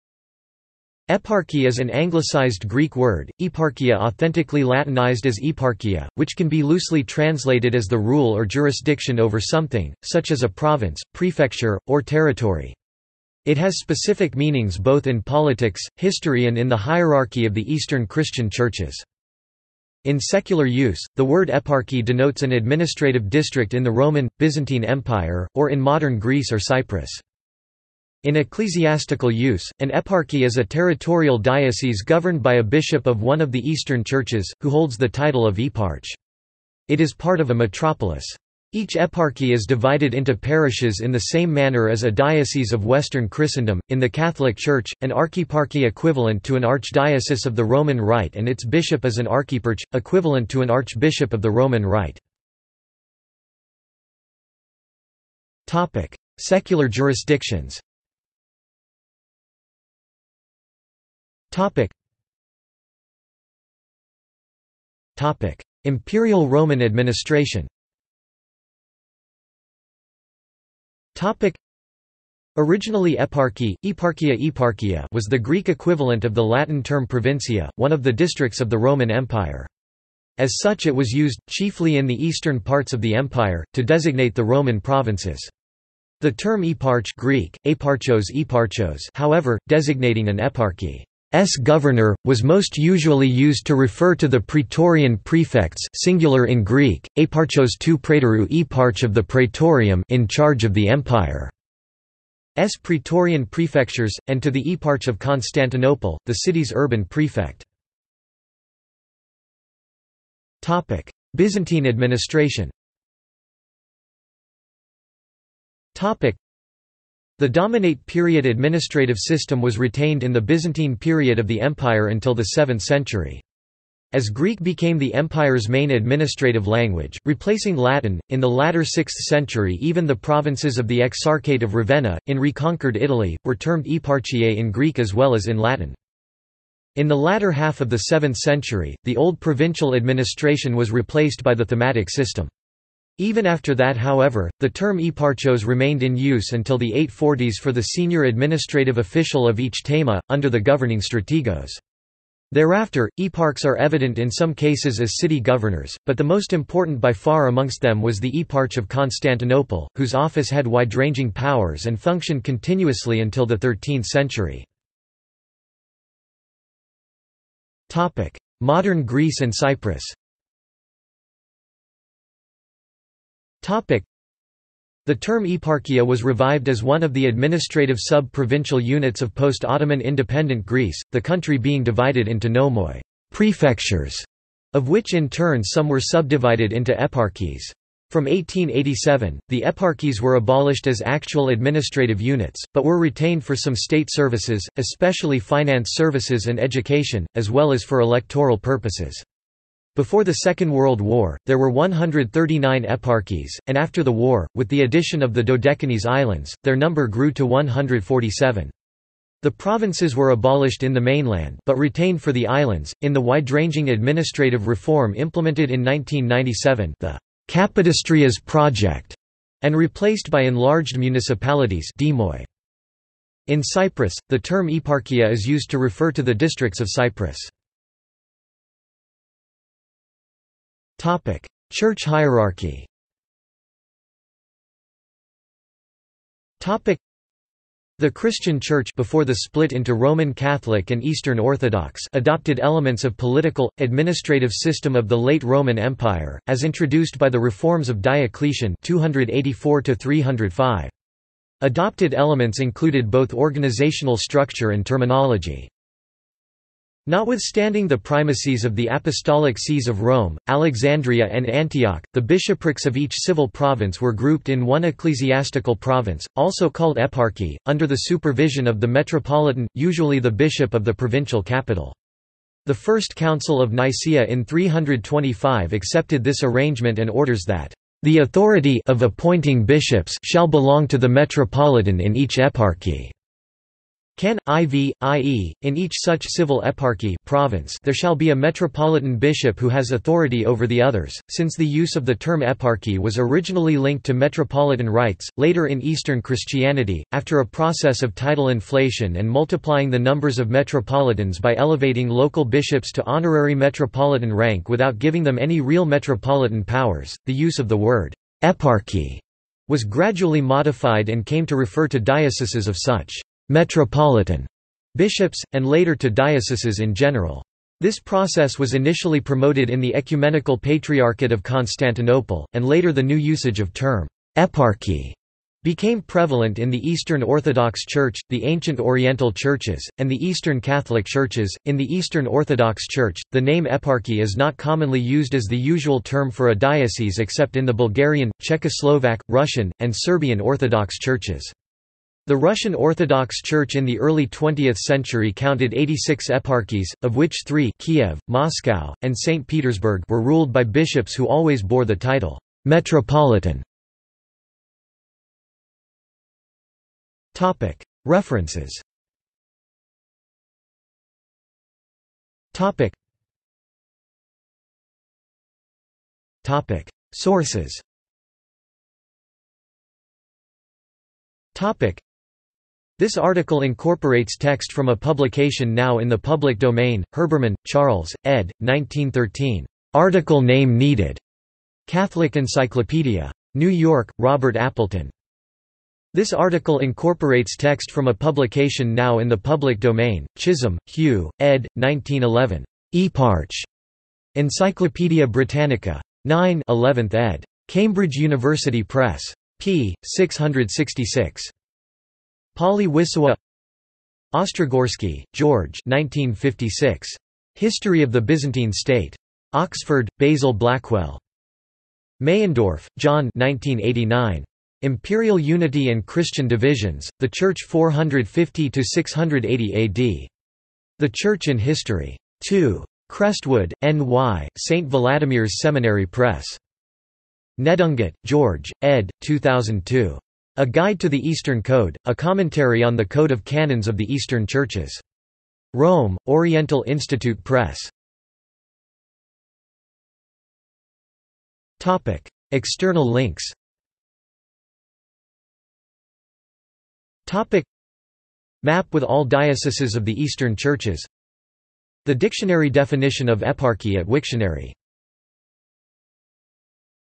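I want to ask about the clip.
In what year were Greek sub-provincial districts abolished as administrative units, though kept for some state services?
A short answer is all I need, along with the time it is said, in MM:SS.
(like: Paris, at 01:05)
1887, at 03:08.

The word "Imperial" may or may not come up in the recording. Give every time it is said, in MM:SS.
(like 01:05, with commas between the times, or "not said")
01:05, 06:54.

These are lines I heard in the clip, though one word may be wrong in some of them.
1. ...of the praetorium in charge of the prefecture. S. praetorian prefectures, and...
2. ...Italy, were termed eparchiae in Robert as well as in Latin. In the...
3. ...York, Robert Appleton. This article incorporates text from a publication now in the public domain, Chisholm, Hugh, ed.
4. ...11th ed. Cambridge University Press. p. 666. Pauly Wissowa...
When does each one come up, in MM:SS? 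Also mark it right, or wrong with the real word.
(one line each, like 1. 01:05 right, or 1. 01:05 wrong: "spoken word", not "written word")
1. 01:39 wrong: "empire", not "prefecture"
2. 02:12 wrong: "Greek", not "Robert"
3. 06:23 right
4. 06:36 right.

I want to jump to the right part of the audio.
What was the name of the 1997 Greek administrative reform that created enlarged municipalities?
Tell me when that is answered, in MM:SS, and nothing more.
03:37.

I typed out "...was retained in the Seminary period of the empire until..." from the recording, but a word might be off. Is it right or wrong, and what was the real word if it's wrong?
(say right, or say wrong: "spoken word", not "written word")
wrong: "Byzantine", not "Seminary".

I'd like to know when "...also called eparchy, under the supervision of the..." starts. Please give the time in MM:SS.
04:26.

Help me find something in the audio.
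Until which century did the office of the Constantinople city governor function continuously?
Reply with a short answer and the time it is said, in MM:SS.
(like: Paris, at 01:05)
13th century, at 02:43.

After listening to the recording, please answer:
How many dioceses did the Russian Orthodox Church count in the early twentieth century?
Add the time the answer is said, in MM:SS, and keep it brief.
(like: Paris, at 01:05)
86, at 05:45.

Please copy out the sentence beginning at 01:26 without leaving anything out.
The term eparch Greek, eparchos eparchos however, designating an eparchy S.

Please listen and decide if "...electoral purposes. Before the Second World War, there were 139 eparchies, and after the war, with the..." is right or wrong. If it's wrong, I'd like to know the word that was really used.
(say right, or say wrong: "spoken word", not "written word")
right.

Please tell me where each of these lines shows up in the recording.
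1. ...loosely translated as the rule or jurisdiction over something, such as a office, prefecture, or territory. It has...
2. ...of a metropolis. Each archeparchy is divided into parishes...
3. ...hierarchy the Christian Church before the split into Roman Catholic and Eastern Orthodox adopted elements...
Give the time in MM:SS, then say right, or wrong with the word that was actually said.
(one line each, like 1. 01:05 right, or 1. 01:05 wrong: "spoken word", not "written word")
1. 00:06 wrong: "province", not "office"
2. 00:37 wrong: "eparchy", not "archeparchy"
3. 03:52 right.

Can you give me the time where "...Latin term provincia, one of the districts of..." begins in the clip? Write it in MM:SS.
01:16.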